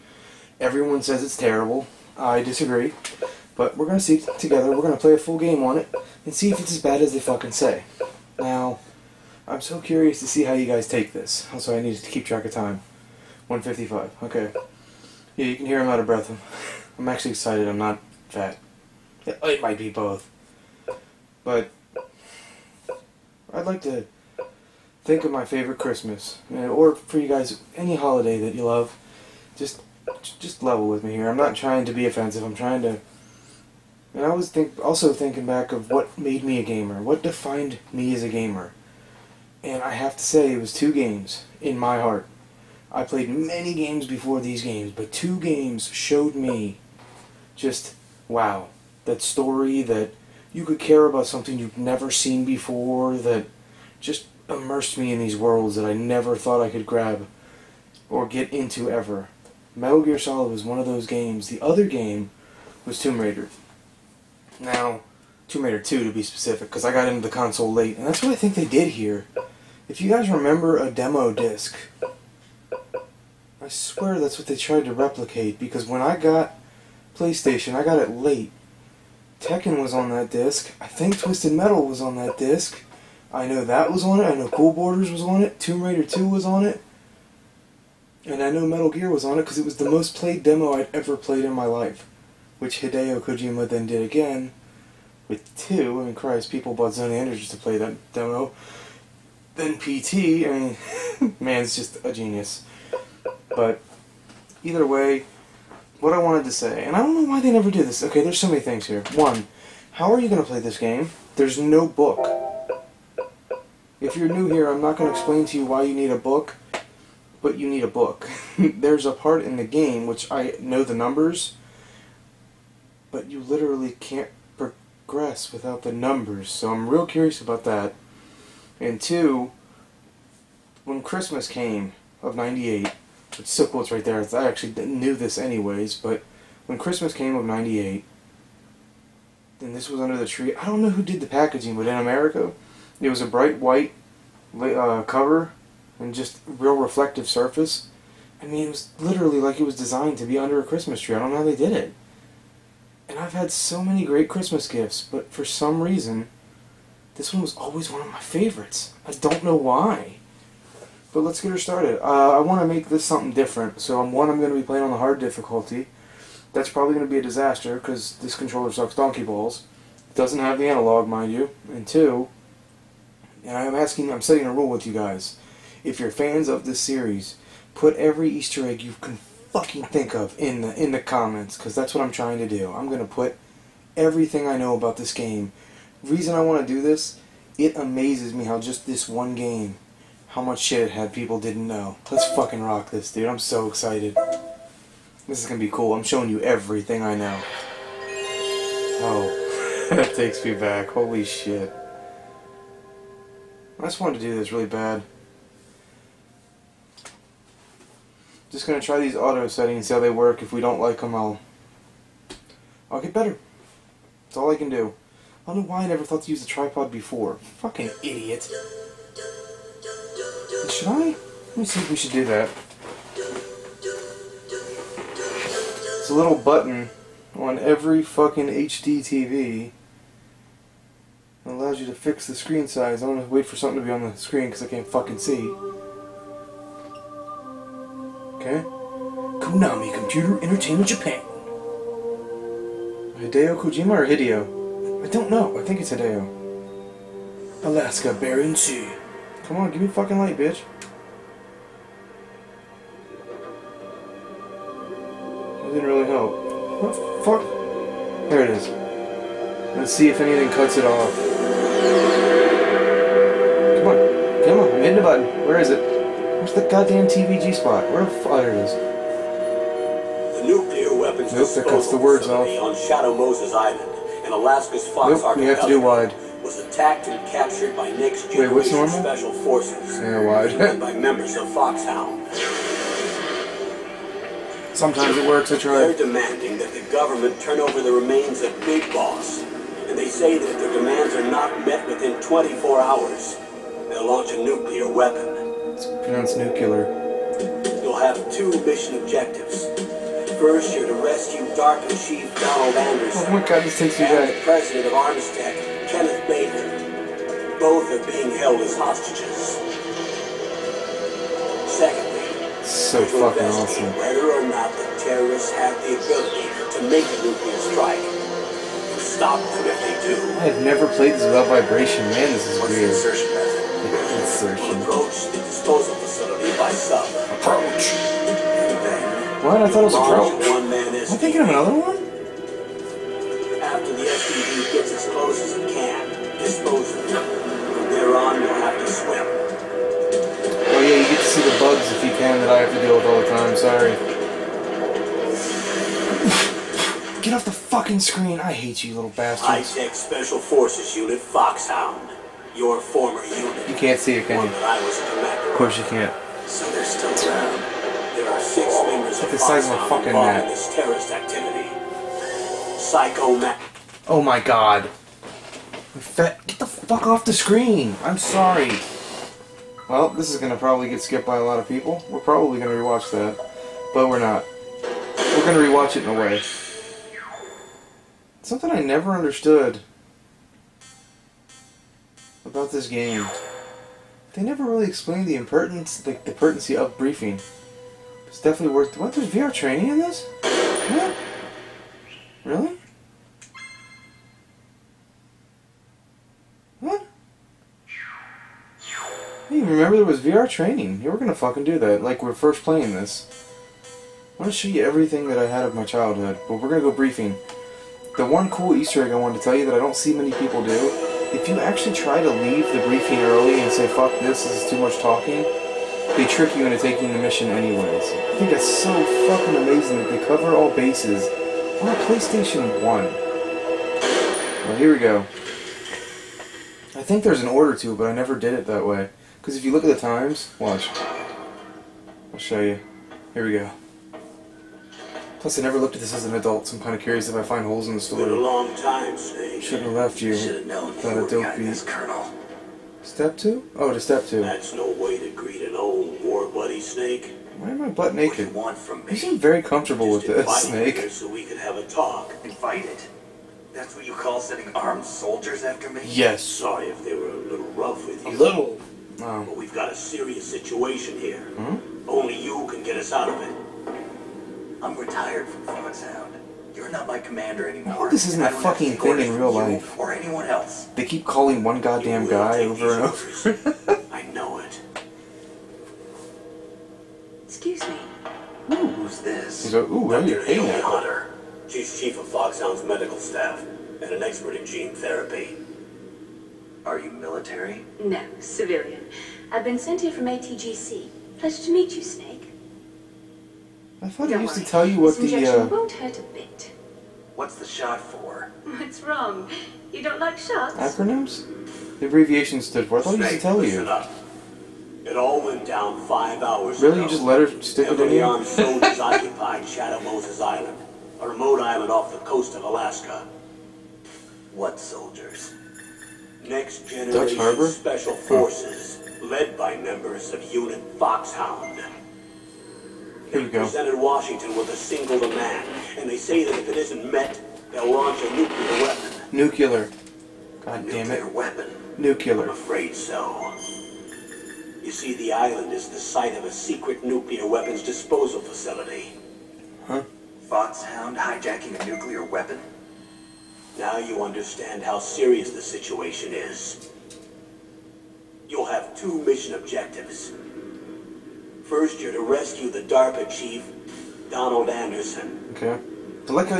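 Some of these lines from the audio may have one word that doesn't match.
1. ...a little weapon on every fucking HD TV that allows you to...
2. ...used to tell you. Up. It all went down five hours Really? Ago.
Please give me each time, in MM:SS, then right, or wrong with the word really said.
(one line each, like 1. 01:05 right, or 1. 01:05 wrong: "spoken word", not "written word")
1. 03:46 wrong: "button", not "weapon"
2. 08:23 right.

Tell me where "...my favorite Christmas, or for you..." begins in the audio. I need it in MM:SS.
00:25.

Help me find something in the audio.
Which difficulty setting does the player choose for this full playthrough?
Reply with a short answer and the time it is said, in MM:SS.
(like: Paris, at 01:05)
Hard, at 02:44.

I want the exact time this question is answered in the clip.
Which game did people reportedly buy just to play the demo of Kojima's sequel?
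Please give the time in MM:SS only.
01:36.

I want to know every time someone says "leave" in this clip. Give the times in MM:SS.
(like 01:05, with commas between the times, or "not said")
06:52.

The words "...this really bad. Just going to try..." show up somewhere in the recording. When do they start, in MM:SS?
03:24.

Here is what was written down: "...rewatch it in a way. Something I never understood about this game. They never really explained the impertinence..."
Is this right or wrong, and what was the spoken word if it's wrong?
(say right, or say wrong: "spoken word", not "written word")
right.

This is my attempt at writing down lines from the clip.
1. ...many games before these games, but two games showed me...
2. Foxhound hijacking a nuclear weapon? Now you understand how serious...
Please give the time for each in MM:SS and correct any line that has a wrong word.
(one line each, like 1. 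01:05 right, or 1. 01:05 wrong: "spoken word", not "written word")
1. 00:43 right
2. 09:00 right.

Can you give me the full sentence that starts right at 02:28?
I mean, it was literally like it was designed to be under a Christmas tree.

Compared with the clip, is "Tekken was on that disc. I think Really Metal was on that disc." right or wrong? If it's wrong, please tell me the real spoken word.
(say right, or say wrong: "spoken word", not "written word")
wrong: "Twisted", not "Really".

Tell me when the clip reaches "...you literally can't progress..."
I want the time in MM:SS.
02:03.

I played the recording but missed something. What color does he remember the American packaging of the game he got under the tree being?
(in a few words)
Bright white.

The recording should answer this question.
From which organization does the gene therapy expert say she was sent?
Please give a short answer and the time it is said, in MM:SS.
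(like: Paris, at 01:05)
ATGC, at 08:10.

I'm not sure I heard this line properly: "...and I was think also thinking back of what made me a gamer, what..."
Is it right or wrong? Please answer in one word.
right.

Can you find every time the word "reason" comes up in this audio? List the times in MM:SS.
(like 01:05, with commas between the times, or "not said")
02:35, 03:06.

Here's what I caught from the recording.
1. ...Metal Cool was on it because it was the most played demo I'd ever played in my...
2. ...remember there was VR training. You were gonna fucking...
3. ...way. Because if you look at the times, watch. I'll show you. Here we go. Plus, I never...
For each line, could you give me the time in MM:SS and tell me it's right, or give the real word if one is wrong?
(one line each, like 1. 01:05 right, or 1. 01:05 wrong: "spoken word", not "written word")
1. 01:28 wrong: "Gear", not "Cool"
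2. 06:39 right
3. 07:08 right.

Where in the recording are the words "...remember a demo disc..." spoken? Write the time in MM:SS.
01:10.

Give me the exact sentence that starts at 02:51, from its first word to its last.
And two, and I'm asking, I'm setting a rule with you guys.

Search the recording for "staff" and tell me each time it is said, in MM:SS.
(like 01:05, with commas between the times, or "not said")
08:03.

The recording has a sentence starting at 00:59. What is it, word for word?
Metal Gear Solid was one of those games.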